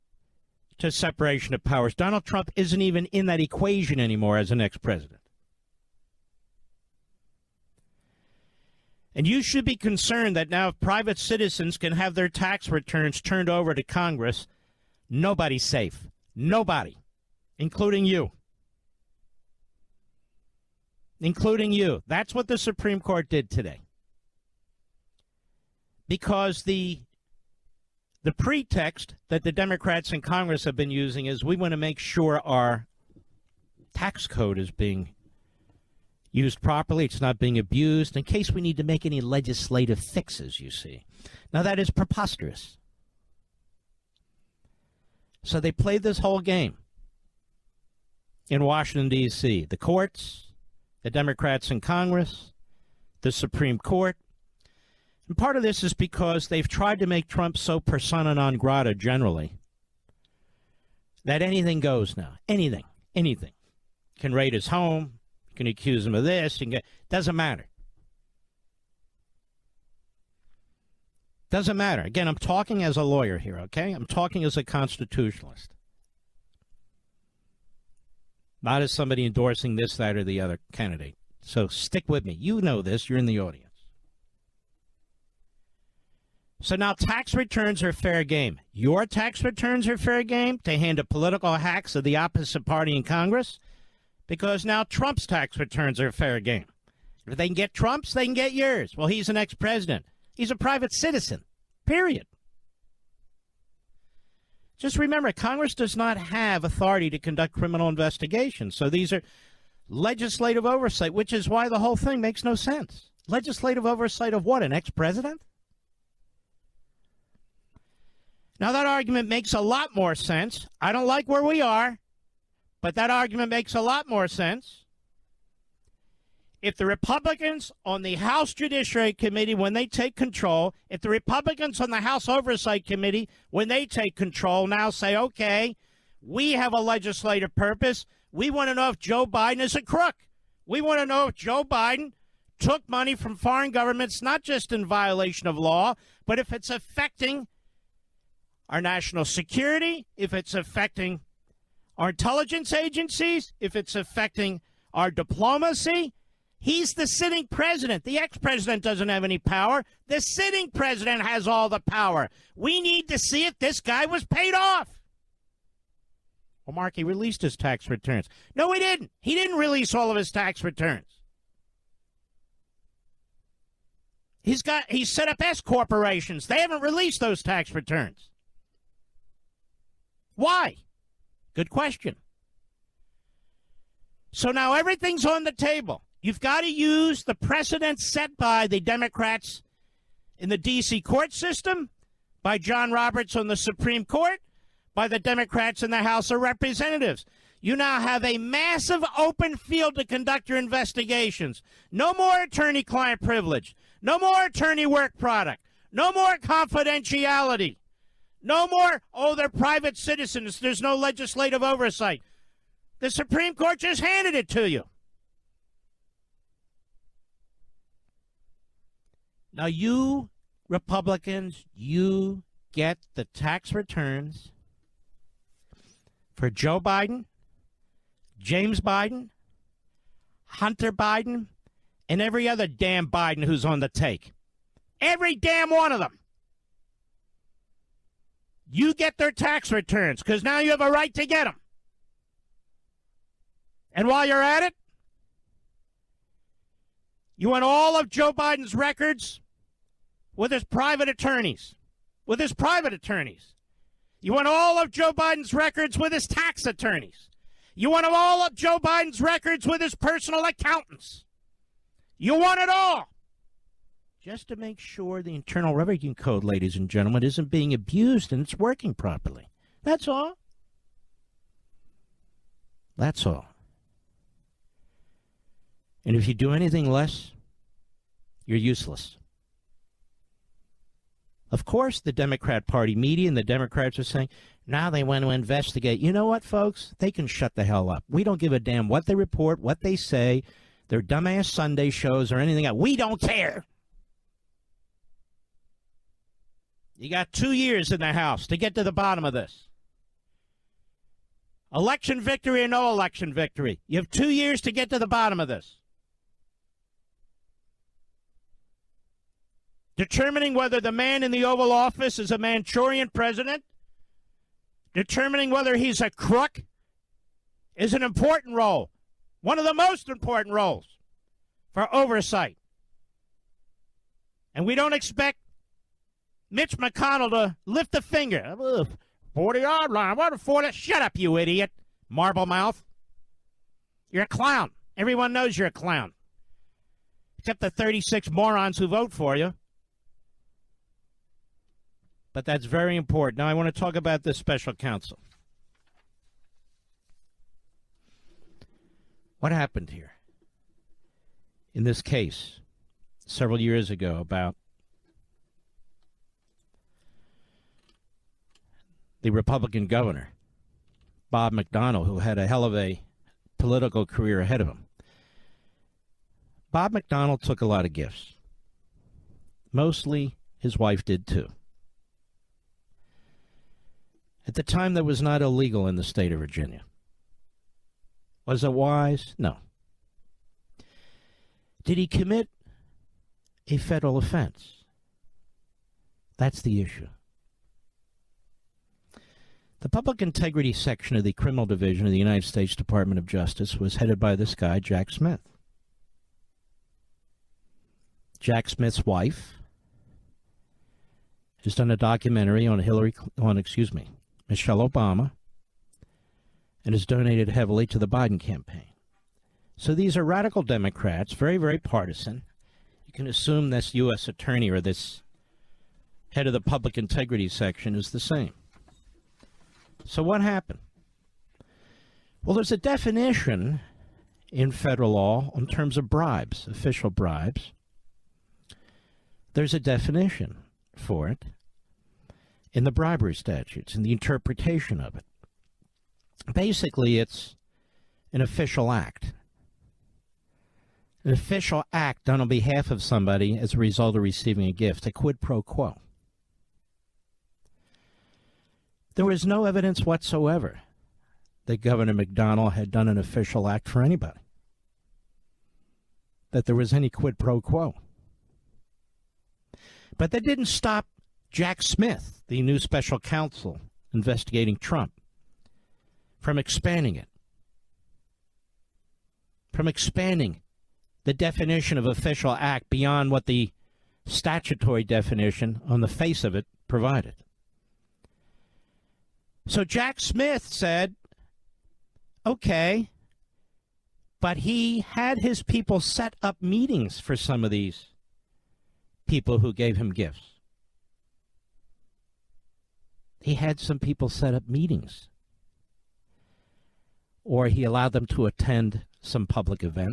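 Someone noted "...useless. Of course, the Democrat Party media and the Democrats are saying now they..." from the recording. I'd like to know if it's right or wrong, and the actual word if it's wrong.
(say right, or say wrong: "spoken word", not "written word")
right.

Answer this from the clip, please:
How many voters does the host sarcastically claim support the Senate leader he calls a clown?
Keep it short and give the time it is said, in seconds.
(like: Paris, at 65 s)
36, at 337 s.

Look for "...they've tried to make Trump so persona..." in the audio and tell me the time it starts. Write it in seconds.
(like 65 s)
56 s.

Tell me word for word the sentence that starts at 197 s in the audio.
You now have a massive open field to conduct your investigations.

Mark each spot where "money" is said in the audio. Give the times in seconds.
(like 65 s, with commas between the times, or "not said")
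142 s.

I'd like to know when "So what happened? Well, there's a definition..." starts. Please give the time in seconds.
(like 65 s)
420 s.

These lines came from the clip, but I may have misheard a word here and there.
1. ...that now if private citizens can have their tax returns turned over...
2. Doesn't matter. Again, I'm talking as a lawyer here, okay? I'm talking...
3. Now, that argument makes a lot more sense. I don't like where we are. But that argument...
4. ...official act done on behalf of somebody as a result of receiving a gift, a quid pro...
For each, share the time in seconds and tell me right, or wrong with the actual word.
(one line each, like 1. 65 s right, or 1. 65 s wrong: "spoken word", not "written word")
1. 10 s right
2. 71 s right
3. 118 s right
4. 441 s right.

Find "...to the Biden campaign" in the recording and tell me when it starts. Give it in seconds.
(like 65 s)
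407 s.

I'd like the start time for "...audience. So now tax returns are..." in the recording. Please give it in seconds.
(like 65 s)
83 s.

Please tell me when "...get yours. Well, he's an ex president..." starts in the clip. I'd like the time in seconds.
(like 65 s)
98 s.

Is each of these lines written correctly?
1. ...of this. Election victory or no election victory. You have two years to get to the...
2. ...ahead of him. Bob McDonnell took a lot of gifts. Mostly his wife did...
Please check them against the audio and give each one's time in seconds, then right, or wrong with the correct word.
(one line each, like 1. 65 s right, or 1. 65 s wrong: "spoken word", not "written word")
1. 299 s right
2. 364 s right.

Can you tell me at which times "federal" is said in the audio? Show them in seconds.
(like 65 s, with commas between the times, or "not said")
383 s, 424 s.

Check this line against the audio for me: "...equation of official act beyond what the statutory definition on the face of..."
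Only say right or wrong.
wrong.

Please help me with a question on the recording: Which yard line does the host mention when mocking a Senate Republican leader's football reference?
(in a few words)
40 yard line.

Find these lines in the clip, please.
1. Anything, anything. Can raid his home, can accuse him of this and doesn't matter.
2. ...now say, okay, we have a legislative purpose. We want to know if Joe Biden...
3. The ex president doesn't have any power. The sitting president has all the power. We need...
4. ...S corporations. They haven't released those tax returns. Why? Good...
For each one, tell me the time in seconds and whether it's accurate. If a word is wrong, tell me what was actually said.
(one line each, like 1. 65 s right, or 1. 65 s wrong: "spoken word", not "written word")
1. 62 s right
2. 134 s right
3. 158 s right
4. 175 s right.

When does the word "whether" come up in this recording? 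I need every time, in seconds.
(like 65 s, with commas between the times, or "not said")
310 s, 315 s.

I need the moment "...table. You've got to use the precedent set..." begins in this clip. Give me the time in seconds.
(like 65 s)
185 s.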